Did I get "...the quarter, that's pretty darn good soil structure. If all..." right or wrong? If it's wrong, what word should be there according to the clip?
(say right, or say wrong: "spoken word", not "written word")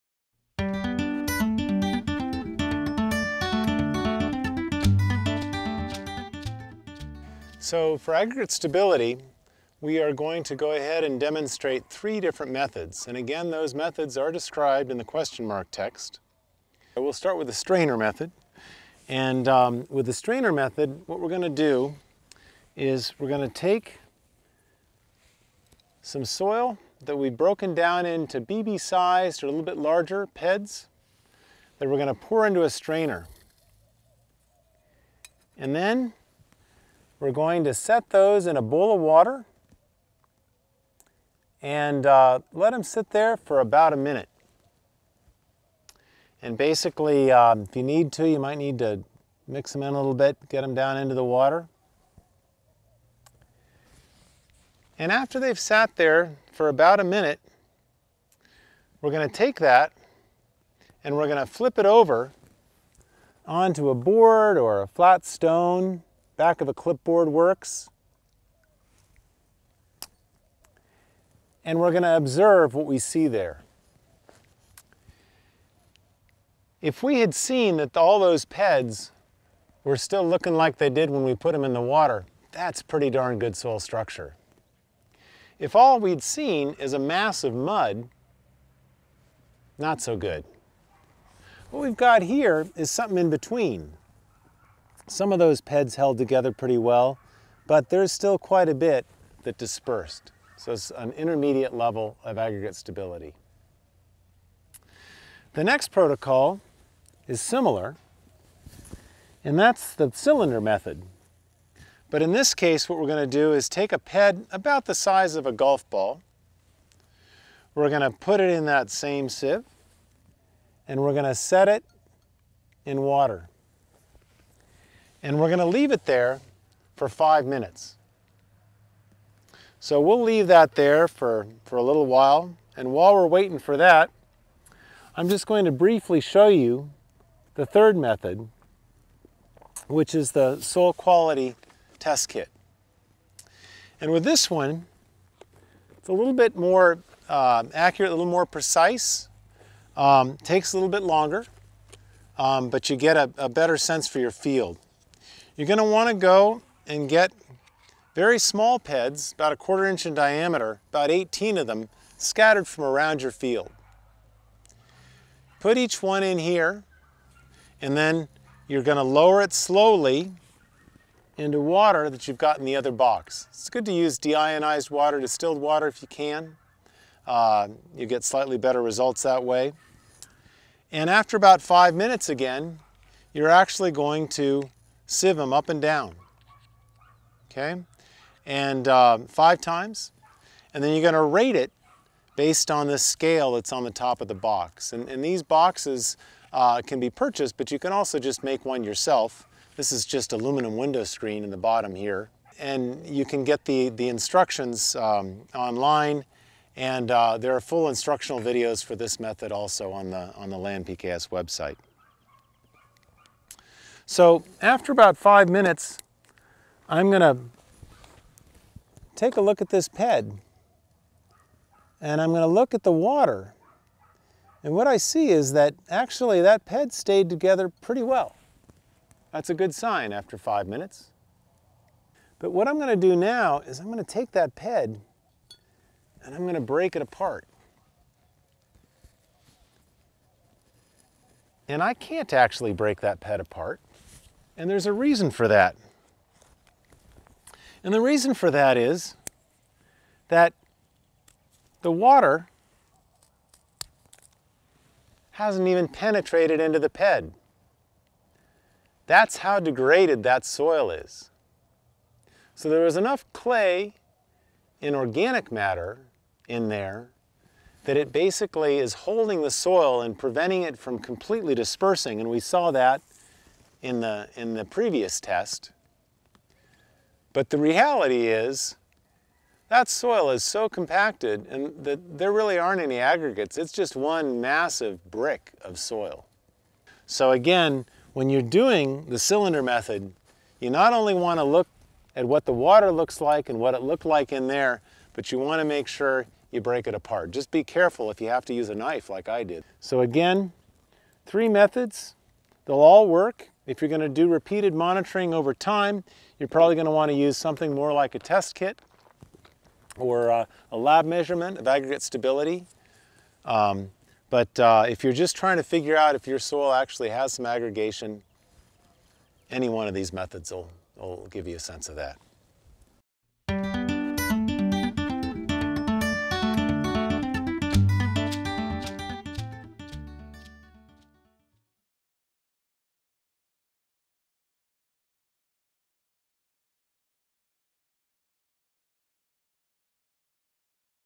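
wrong: "water", not "quarter".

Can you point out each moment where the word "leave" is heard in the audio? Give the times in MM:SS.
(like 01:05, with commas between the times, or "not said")
02:05, 02:10.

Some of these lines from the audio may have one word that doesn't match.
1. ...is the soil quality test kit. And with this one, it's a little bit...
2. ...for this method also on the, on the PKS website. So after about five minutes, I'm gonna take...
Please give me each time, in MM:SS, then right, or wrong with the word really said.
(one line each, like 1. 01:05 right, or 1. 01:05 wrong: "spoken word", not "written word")
1. 02:20 right
2. 03:28 right.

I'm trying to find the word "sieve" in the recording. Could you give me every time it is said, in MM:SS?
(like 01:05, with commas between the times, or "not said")
01:59, 03:05.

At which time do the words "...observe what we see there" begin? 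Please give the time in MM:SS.
01:12.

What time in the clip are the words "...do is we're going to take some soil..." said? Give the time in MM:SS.
00:21.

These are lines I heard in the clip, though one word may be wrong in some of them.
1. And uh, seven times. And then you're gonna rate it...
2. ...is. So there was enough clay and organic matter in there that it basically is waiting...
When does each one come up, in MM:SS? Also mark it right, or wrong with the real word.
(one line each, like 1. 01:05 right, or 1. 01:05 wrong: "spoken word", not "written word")
1. 03:08 wrong: "five", not "seven"
2. 04:20 wrong: "holding", not "waiting".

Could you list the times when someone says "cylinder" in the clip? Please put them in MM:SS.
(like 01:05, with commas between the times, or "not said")
01:50, 04:49.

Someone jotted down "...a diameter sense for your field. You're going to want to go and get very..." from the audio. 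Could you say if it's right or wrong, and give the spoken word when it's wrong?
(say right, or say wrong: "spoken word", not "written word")
wrong: "better", not "diameter".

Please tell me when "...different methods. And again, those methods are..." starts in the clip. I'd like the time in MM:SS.
00:12.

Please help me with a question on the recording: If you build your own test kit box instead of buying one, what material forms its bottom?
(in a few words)
aluminum window screen.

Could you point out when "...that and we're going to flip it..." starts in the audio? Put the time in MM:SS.
00:59.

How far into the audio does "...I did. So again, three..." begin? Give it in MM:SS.
04:59.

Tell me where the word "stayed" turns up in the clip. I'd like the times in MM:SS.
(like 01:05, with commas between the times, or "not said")
03:46.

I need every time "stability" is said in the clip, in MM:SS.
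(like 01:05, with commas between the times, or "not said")
00:08, 01:42, 05:12.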